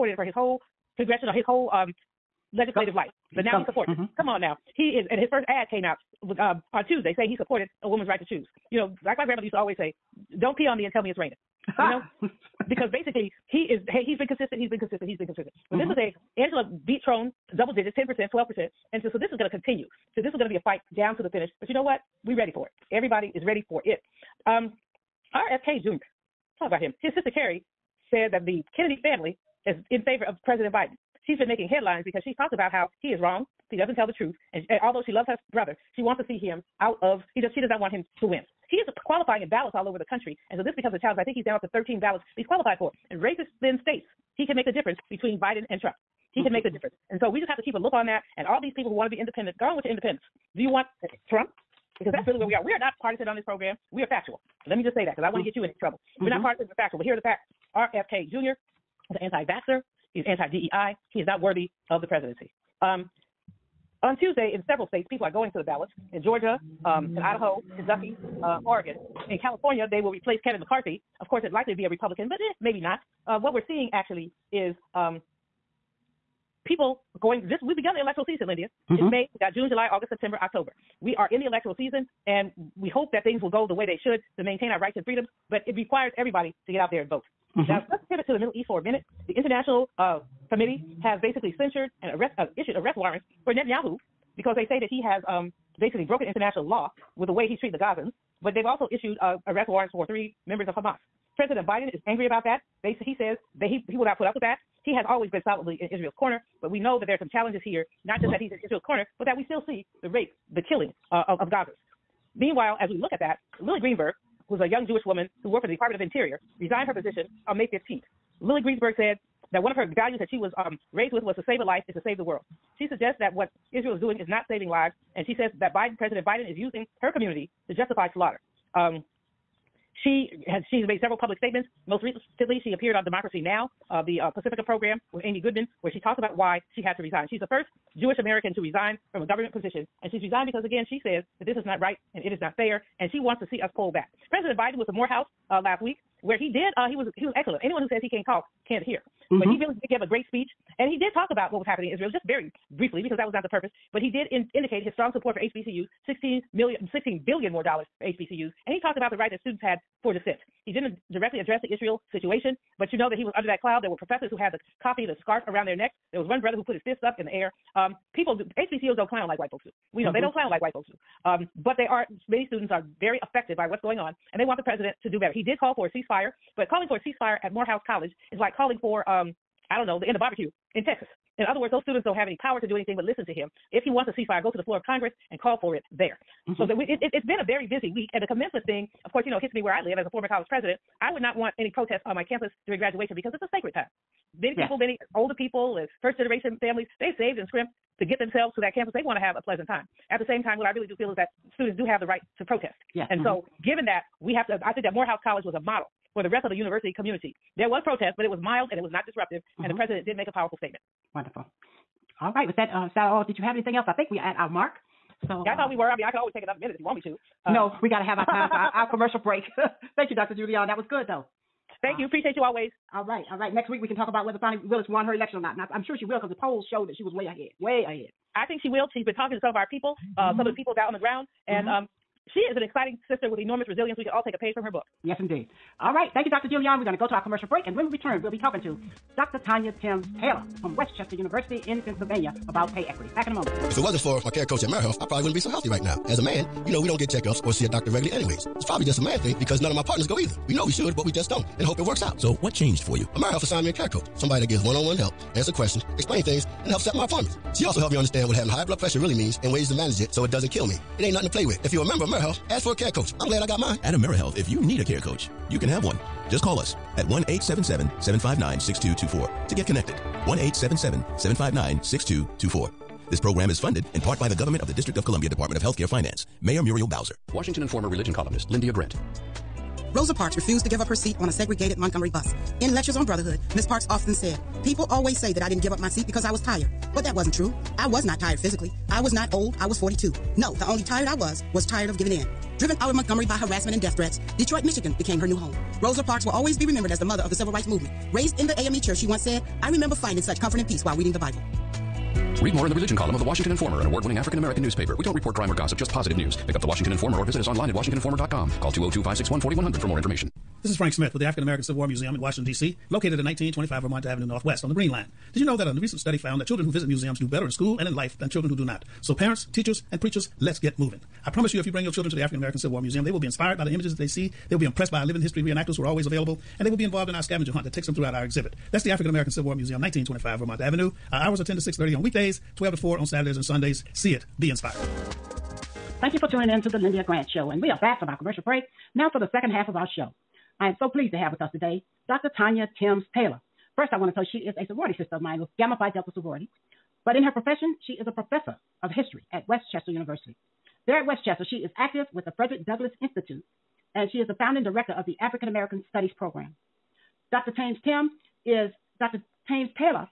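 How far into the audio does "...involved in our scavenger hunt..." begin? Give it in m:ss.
5:26.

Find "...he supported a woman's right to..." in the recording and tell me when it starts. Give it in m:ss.
0:07.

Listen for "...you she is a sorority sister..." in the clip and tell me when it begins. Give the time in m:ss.
5:44.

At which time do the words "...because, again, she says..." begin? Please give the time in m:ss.
2:20.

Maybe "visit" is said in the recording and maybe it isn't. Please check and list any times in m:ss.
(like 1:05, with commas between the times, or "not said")
5:07, 5:16.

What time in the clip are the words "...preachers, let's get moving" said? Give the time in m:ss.
5:20.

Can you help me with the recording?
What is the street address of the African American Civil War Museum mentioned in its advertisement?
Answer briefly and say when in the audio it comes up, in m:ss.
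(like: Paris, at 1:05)
1925 Vermont Avenue Northwest, at 5:13.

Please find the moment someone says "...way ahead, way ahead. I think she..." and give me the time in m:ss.
3:47.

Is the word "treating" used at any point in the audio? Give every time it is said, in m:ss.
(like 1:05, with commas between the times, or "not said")
1:37.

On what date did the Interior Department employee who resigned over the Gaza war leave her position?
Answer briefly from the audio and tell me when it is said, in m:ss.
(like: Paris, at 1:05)
May 15th, at 1:57.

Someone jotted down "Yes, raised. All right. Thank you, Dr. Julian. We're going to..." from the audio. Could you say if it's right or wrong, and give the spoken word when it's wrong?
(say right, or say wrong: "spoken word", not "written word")
wrong: "indeed", not "raised".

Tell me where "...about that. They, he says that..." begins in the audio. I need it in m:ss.
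1:42.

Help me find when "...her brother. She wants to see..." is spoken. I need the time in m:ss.
0:35.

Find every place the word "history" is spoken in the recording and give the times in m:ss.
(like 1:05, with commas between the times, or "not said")
5:25, 5:48.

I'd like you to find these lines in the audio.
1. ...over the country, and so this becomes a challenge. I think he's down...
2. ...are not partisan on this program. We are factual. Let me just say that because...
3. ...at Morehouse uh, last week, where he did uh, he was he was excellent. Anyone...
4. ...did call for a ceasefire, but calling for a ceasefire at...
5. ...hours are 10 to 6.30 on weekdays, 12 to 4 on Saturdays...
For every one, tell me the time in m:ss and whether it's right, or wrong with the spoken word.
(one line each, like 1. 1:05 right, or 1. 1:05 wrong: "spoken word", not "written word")
1. 0:39 right
2. 0:52 right
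3. 2:24 right
4. 2:55 right
5. 5:31 right.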